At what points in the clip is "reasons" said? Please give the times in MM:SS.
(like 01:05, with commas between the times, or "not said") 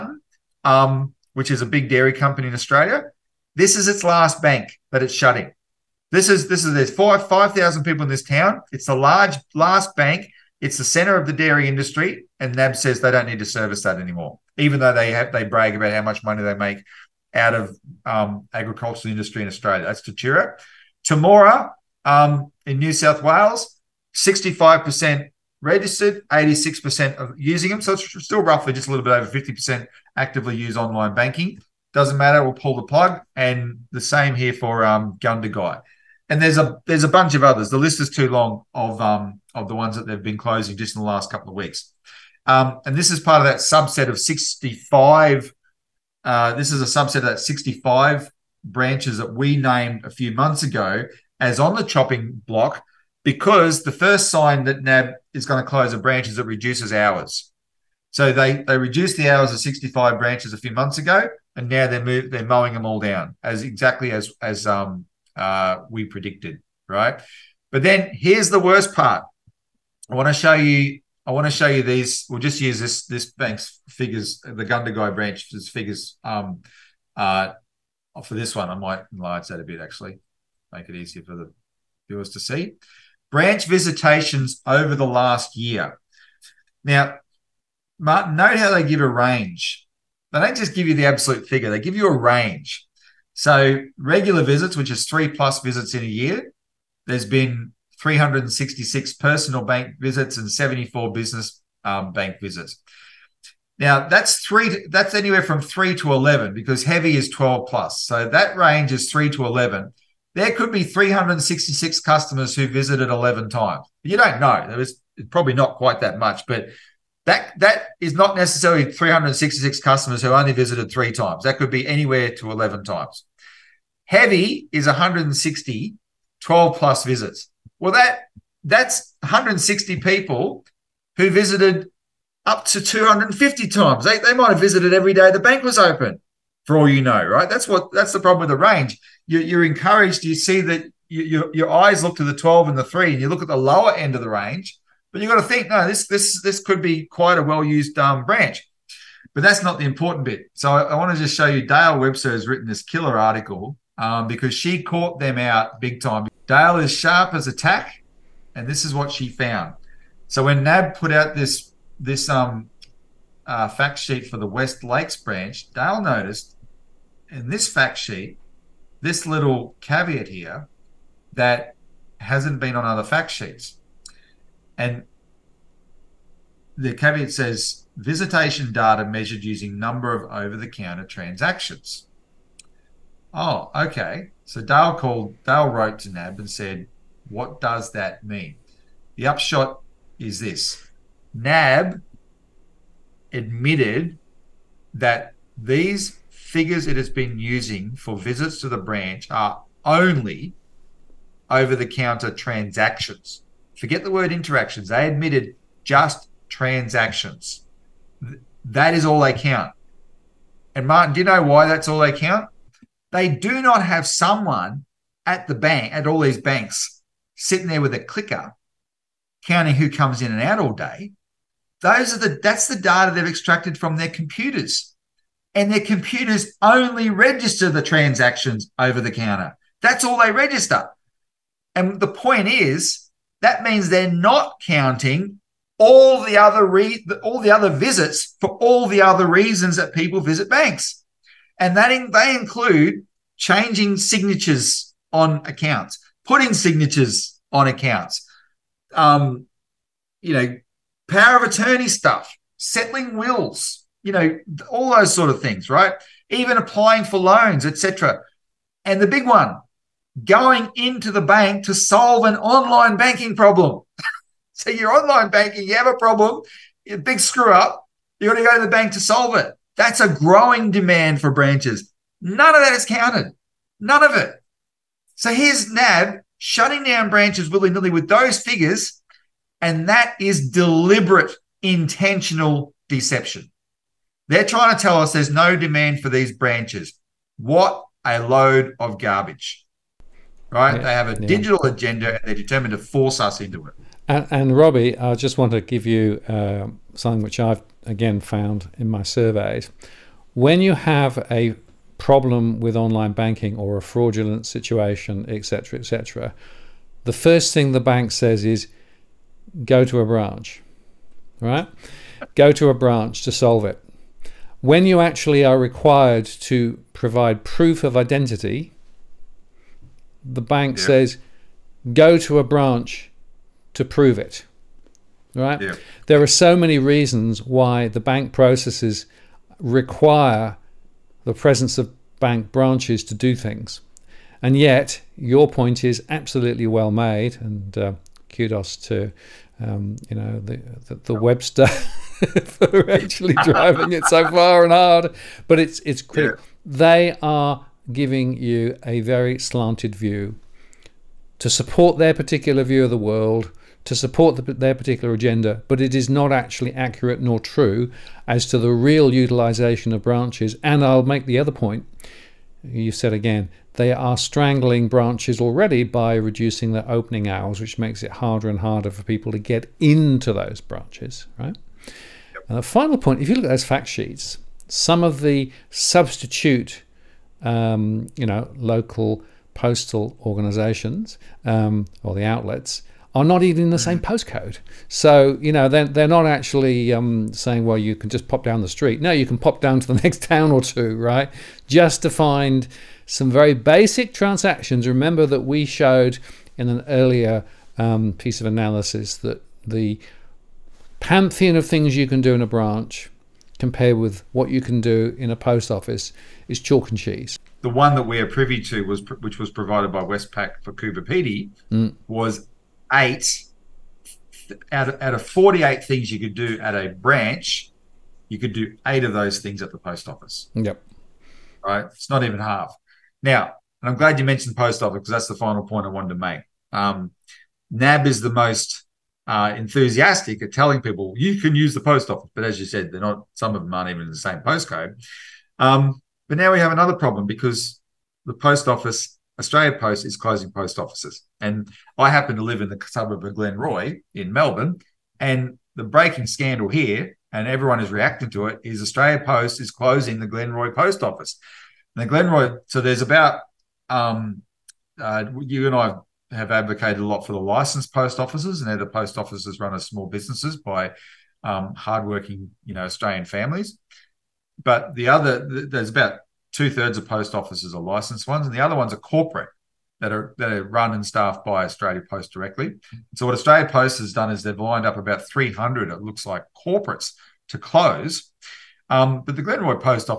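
03:59, 05:26.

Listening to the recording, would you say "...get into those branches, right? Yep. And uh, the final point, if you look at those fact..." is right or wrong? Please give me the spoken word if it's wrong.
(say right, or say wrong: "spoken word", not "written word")
right.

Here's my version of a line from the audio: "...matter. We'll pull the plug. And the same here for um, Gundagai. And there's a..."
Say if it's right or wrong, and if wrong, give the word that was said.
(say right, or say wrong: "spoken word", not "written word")
right.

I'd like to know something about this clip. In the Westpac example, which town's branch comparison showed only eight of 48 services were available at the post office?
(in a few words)
Coober Pedy.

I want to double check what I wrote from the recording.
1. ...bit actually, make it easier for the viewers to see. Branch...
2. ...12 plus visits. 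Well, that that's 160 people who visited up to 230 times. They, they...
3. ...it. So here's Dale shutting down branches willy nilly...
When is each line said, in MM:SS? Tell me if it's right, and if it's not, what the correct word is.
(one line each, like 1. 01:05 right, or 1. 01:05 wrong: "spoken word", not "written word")
1. 01:19 right
2. 02:06 wrong: "250", not "230"
3. 04:34 wrong: "NAB", not "Dale".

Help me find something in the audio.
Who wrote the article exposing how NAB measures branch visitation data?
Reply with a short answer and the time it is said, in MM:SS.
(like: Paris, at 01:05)
Dale Webster, at 02:31.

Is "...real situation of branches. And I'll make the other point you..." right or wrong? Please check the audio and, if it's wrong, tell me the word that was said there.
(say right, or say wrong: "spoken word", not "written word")
wrong: "utilization", not "situation".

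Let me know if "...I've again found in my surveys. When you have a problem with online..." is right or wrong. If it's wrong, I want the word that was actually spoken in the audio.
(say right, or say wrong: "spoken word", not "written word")
right.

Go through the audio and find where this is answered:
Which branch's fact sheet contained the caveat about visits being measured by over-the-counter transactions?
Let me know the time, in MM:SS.
02:44.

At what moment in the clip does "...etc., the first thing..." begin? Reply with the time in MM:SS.
05:05.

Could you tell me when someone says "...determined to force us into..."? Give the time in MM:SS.
04:52.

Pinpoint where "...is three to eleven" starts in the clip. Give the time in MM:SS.
01:48.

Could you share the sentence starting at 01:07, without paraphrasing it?
But then here's the worst part.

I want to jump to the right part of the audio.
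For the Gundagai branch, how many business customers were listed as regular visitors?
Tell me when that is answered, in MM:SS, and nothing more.
01:40.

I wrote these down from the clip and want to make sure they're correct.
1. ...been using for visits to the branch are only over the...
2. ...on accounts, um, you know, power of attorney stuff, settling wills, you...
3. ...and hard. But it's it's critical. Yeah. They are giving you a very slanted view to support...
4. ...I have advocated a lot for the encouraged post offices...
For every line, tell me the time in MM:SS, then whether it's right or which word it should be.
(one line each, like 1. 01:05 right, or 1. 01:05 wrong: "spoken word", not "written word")
1. 03:17 right
2. 04:07 right
3. 05:44 right
4. 07:35 wrong: "licensed", not "encouraged".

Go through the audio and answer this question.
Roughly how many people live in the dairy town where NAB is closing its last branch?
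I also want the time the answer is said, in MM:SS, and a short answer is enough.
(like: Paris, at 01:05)
5,000, at 00:07.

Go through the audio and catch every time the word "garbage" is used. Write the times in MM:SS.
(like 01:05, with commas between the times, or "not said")
04:48.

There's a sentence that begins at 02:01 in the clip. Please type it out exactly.
That could be anywhere to 11 times.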